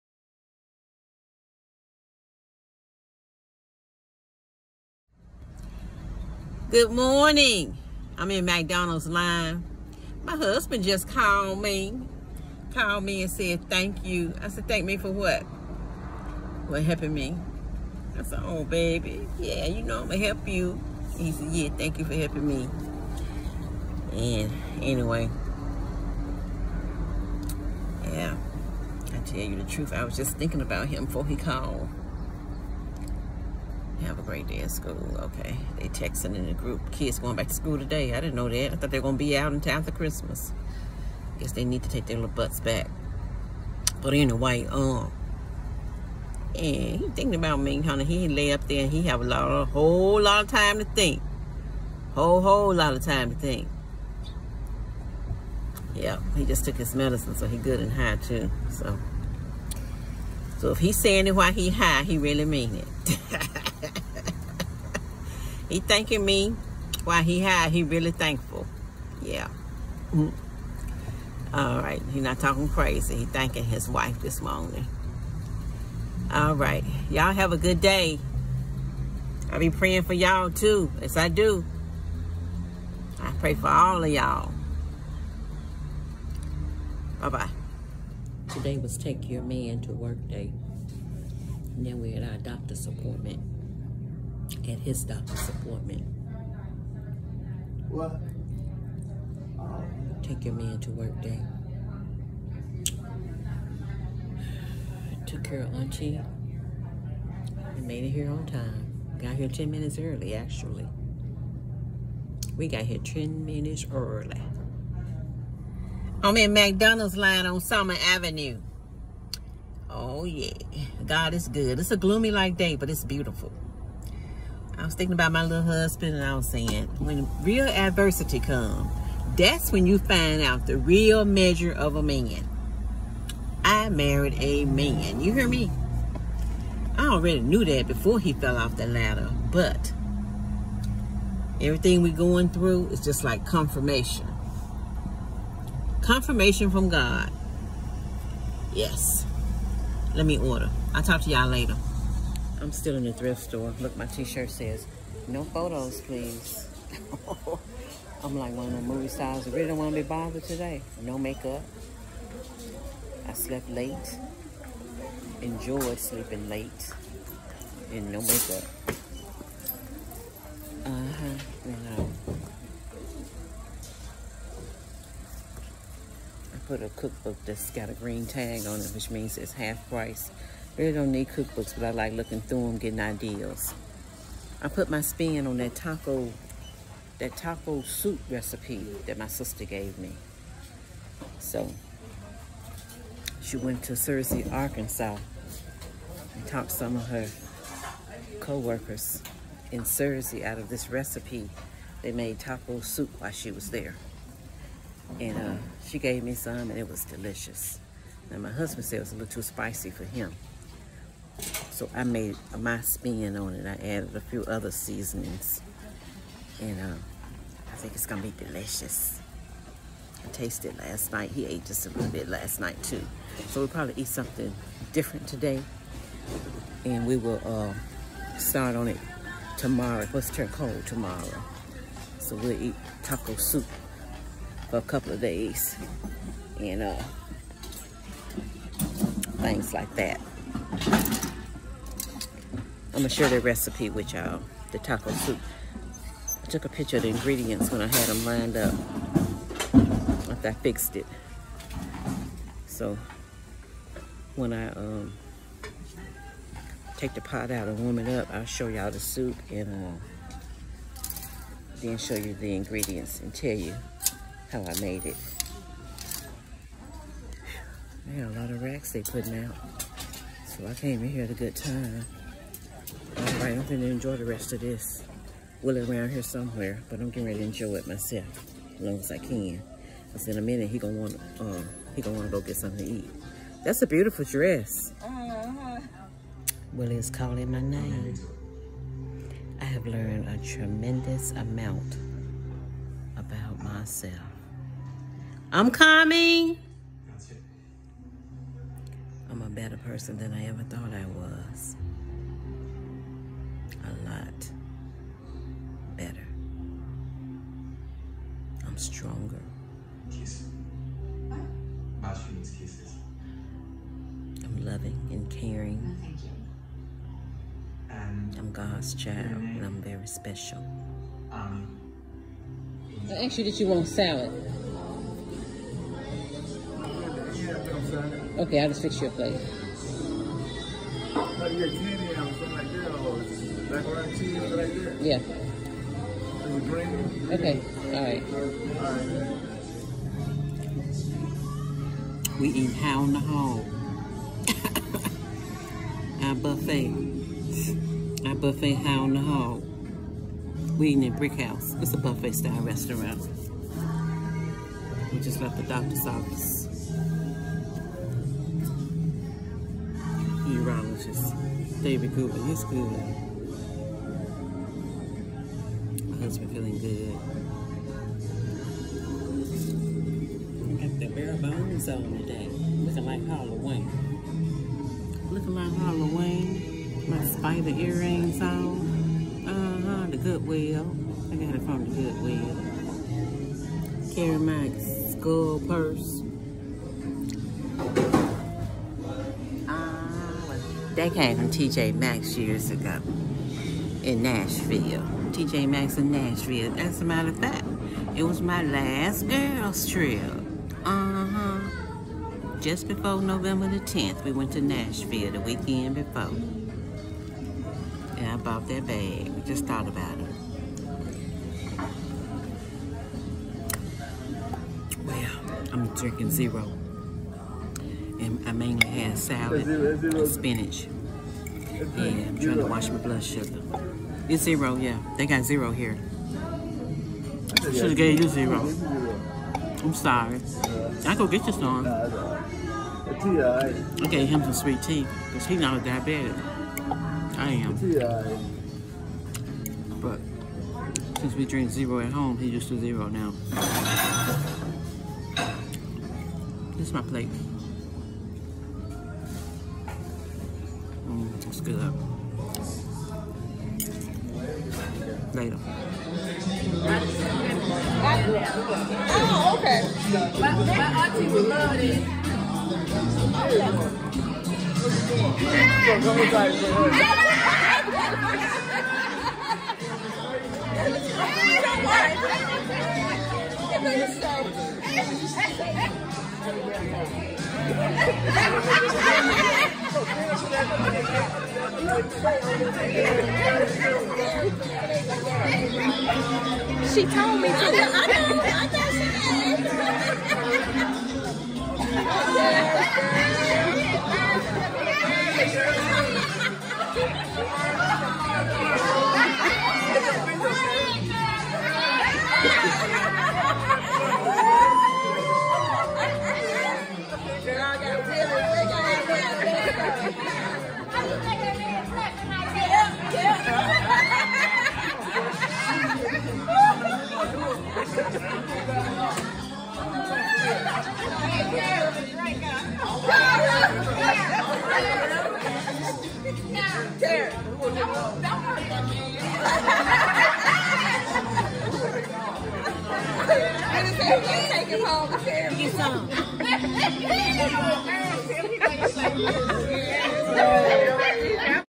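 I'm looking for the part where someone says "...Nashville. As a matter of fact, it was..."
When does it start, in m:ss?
6:36.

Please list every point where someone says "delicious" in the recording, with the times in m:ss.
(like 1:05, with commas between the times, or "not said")
3:27, 3:38.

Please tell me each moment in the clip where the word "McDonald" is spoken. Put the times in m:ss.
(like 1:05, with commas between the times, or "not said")
0:08, 1:56.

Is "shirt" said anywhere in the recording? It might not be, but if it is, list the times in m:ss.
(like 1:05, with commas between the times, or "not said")
2:34.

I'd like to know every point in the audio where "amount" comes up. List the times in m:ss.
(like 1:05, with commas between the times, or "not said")
4:51.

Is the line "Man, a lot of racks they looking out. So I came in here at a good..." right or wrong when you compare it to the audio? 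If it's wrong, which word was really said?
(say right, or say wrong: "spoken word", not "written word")
wrong: "putting", not "looking".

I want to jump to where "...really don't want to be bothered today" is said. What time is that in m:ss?
2:39.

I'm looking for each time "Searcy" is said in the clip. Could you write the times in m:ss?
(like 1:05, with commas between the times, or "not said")
3:13, 3:19.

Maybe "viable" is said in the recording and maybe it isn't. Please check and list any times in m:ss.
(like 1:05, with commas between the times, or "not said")
not said.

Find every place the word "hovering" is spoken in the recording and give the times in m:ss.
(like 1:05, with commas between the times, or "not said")
not said.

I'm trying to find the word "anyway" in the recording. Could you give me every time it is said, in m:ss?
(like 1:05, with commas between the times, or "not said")
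0:24, 0:44.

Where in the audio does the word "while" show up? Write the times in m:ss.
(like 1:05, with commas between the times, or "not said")
1:01, 1:07, 3:23.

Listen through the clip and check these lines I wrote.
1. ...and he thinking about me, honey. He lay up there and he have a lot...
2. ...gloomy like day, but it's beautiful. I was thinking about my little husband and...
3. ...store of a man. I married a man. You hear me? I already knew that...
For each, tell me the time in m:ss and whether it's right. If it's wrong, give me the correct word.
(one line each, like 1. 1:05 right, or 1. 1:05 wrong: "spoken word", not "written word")
1. 0:46 right
2. 2:01 right
3. 2:11 wrong: "measure", not "store".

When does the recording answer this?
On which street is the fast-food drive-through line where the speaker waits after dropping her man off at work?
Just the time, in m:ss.
1:57.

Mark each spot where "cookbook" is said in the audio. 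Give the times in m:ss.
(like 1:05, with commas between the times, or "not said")
2:56, 3:01.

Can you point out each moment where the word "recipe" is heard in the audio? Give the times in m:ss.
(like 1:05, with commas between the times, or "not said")
3:08, 3:20, 4:03.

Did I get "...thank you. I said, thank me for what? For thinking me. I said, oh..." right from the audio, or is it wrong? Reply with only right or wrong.
wrong.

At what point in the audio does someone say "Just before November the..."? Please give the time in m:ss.
6:42.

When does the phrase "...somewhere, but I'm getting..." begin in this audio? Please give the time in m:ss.
4:36.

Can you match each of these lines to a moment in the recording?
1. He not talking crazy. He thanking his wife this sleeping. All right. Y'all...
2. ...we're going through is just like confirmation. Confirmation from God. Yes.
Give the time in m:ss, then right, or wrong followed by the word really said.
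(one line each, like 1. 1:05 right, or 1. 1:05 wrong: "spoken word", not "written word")
1. 1:12 wrong: "morning", not "sleeping"
2. 2:22 right.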